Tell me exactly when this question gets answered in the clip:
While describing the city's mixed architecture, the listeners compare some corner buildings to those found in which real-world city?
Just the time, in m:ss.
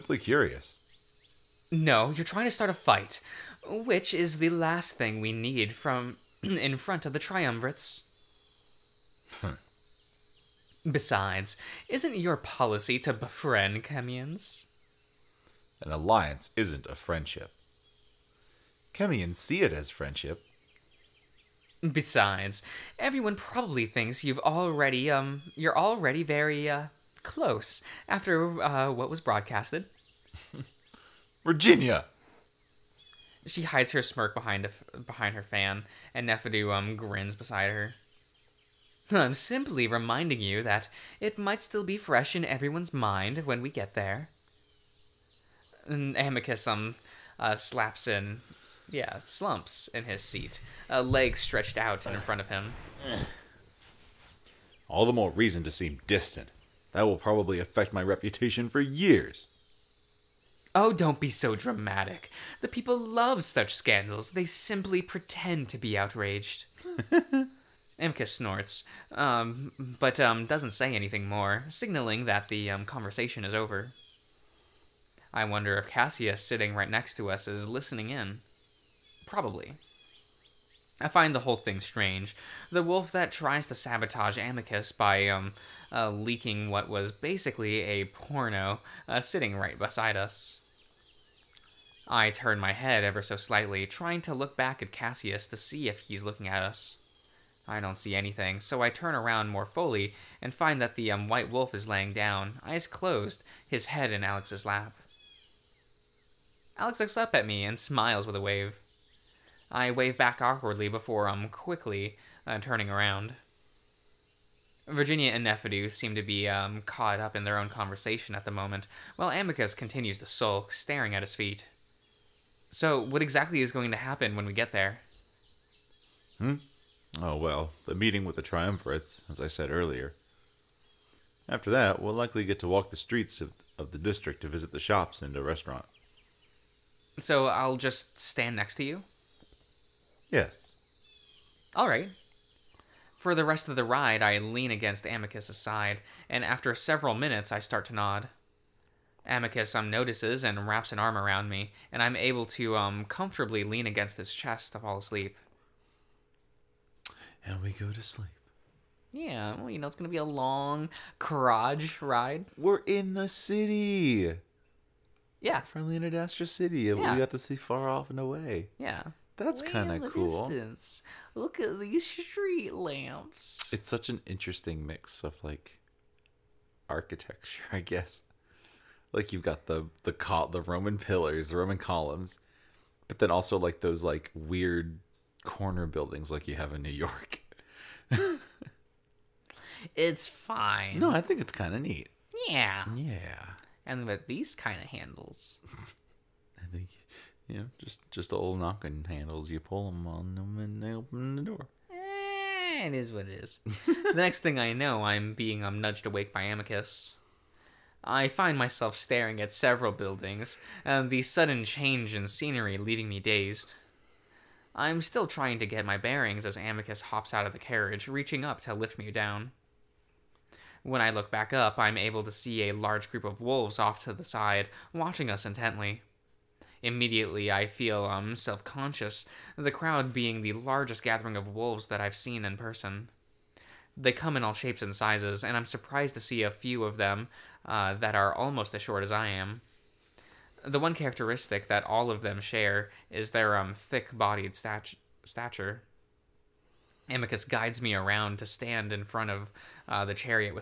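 3:06.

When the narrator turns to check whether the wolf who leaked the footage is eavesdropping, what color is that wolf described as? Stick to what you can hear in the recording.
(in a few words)
white.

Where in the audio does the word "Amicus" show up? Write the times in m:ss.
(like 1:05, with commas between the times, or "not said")
0:46, 1:24, 1:59, 2:25, 2:29, 3:26, 3:36, 4:07.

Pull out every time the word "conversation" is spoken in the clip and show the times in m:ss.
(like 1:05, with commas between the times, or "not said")
1:12, 1:57.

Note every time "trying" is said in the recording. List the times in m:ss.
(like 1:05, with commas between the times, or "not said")
0:02, 1:33, 3:35.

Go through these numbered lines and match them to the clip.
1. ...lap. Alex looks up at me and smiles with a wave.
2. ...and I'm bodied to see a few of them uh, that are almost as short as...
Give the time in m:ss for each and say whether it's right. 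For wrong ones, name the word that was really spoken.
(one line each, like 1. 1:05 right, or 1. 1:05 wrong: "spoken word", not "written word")
1. 1:44 right
2. 3:55 wrong: "surprised", not "bodied".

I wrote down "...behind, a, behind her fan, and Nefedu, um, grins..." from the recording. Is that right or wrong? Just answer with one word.
right.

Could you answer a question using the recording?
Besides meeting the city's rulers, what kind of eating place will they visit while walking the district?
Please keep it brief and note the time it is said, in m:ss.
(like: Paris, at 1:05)
a restaurant, at 2:15.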